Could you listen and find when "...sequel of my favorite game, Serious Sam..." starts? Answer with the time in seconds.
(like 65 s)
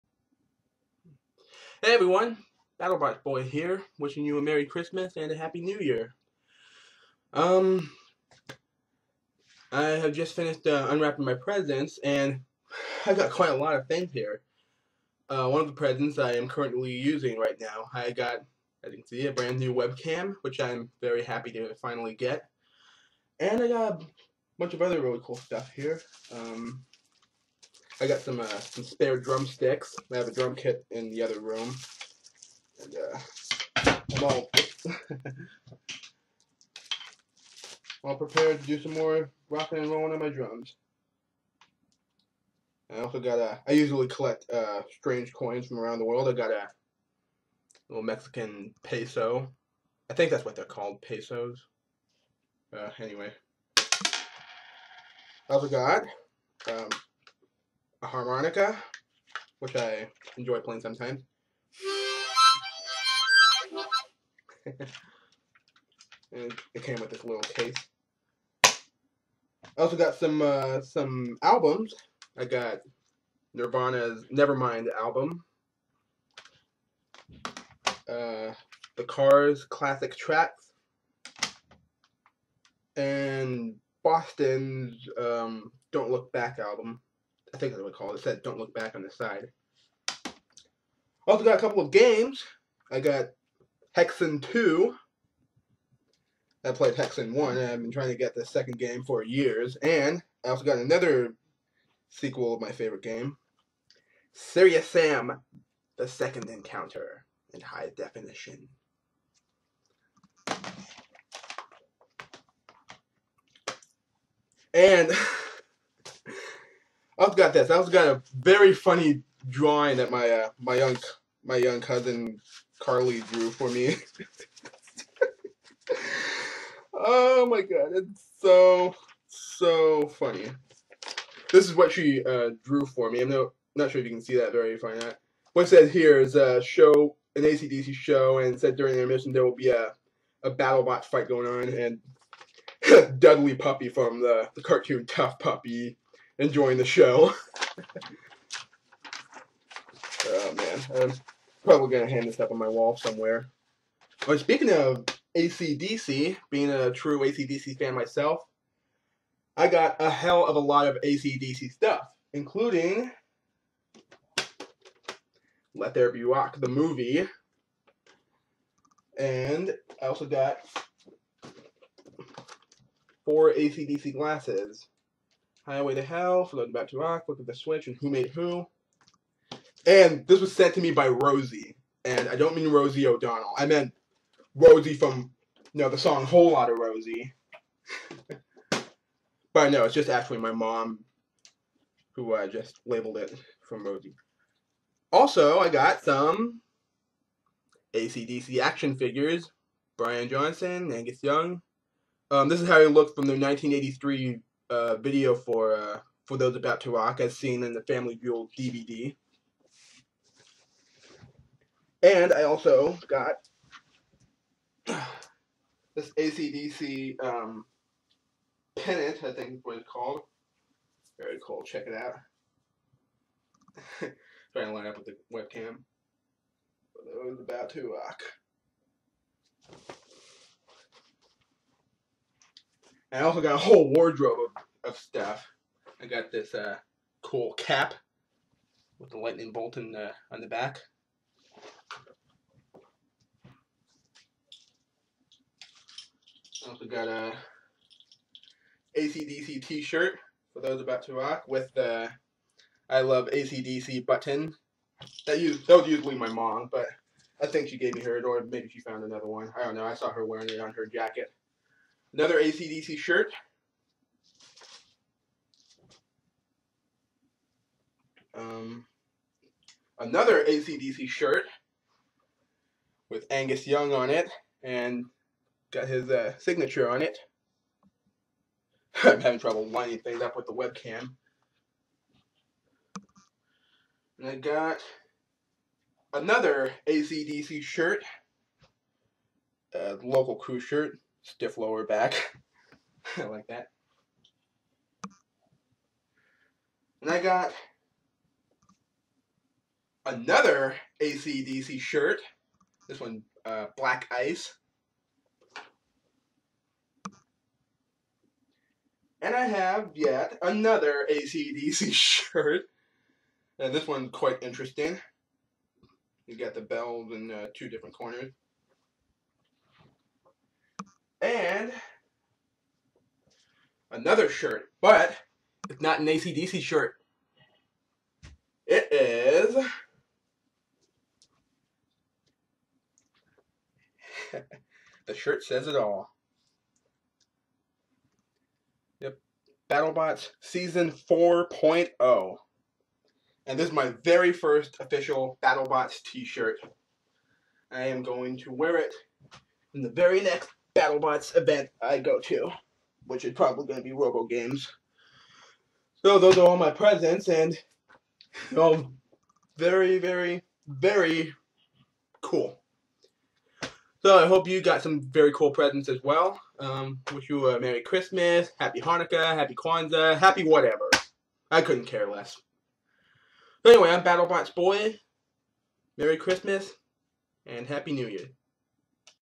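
102 s.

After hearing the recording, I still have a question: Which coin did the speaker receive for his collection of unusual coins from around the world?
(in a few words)
Mexican peso.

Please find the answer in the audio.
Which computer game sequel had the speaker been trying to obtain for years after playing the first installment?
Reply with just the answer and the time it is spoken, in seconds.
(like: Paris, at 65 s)
Hexen 2, at 93 s.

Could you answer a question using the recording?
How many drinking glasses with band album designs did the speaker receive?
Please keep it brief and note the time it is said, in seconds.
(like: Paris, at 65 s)
4, at 173 s.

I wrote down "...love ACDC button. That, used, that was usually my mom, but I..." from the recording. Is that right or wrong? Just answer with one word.
right.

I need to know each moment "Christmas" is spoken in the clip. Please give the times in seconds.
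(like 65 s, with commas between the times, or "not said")
4 s, 367 s, 376 s.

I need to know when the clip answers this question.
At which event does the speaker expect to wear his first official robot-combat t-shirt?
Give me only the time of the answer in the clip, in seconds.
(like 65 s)
353 s.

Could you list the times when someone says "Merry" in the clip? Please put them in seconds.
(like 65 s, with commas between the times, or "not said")
4 s, 367 s, 375 s.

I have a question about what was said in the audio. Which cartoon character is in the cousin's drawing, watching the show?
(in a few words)
Dudley Puppy.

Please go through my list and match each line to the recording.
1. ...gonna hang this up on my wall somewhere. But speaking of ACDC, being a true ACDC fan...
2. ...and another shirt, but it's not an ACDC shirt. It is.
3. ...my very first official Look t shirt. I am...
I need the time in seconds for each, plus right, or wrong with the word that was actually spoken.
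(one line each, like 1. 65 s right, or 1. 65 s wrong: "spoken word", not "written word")
1. 151 s right
2. 321 s right
3. 343 s wrong: "BattleBots", not "Look".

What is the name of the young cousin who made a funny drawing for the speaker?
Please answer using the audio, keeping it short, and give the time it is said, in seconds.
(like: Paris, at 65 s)
Carly, at 122 s.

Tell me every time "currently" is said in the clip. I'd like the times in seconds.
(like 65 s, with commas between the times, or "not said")
16 s.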